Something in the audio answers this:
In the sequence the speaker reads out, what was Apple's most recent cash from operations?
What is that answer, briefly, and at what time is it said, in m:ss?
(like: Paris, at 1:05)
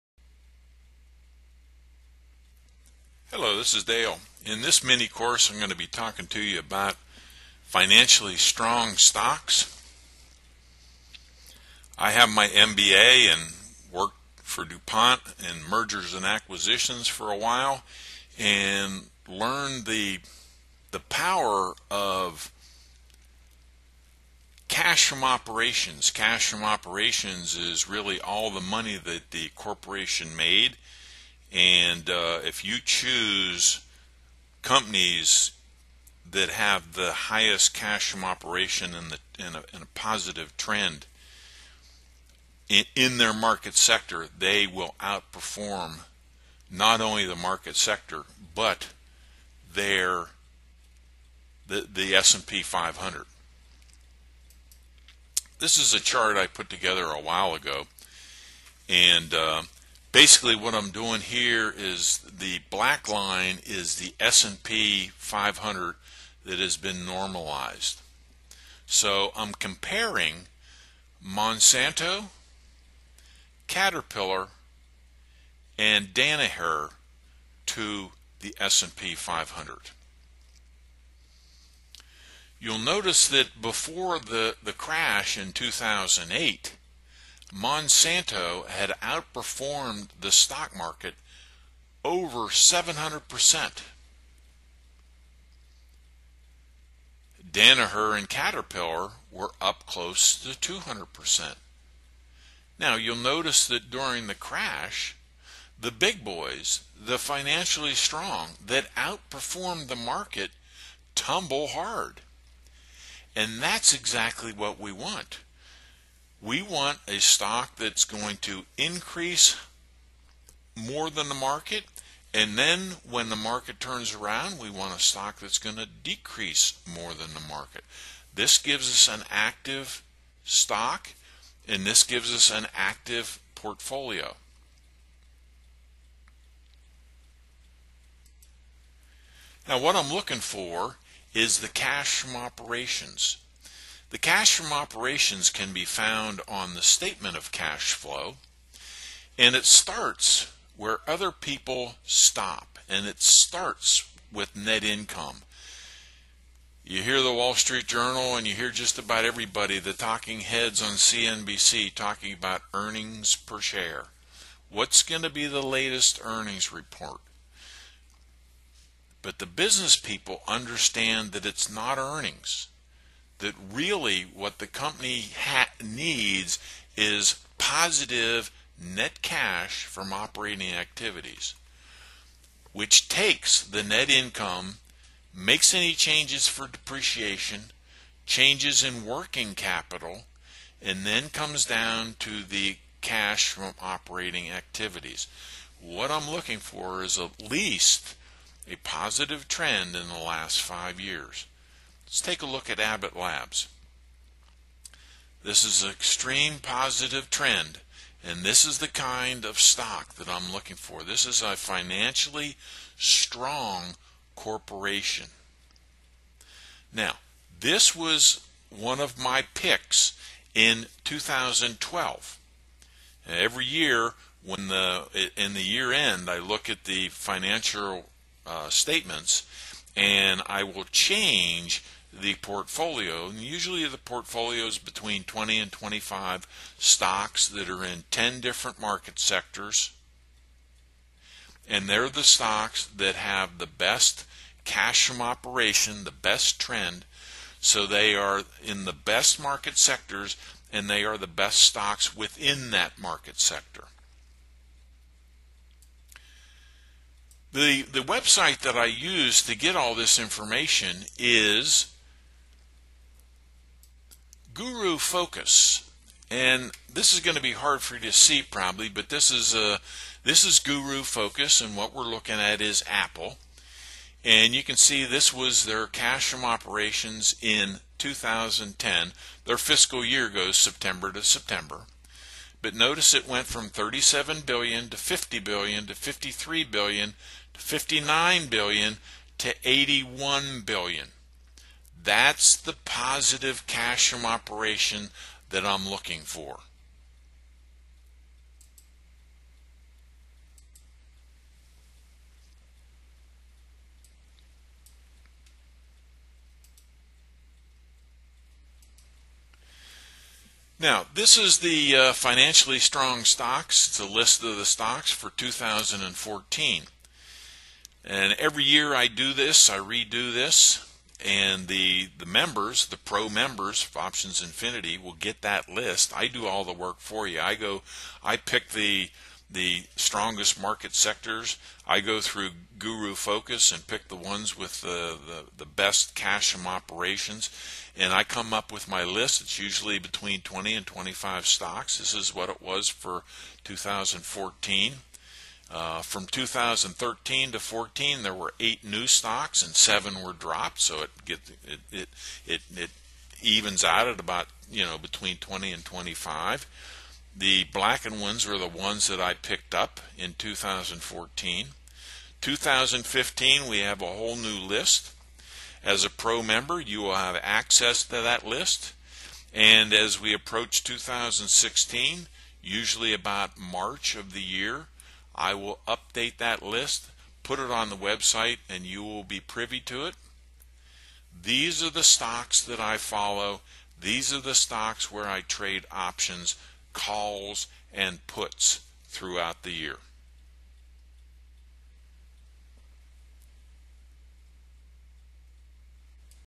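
81 billion, at 4:49.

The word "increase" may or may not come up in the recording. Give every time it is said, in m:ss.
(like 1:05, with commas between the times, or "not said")
1:58.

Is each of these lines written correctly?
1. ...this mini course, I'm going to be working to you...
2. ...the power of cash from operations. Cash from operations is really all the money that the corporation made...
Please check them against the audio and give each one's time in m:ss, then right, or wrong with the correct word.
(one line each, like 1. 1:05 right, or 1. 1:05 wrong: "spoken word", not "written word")
1. 0:04 wrong: "talking", not "working"
2. 0:20 right.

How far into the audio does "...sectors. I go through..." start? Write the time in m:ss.
5:30.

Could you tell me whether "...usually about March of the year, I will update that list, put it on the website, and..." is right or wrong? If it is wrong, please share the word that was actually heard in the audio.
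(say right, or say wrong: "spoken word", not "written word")
right.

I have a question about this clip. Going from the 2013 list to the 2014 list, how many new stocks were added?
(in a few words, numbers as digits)
8.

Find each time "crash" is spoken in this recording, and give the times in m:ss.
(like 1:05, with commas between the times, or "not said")
1:24, 1:44.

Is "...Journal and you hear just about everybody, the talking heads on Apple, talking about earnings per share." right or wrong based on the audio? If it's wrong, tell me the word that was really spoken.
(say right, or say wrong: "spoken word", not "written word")
wrong: "CNBC", not "Apple".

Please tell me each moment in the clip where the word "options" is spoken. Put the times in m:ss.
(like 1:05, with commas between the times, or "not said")
5:23, 6:25.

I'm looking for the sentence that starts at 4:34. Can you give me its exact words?
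And you can see this was their cash from operations in 2010.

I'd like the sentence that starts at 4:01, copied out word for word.
And they're the stocks that have the best cash from operation, the best trend.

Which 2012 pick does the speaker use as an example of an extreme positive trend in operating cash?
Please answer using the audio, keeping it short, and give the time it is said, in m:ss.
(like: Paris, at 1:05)
Abbott Labs, at 3:22.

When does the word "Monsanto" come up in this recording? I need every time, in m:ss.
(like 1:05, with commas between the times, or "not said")
1:11, 1:27.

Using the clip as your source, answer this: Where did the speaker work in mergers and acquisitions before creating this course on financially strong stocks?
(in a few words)
DuPont.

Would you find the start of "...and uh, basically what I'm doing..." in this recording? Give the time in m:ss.
0:58.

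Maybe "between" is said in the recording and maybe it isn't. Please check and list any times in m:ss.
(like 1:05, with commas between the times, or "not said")
3:54, 5:39, 5:54.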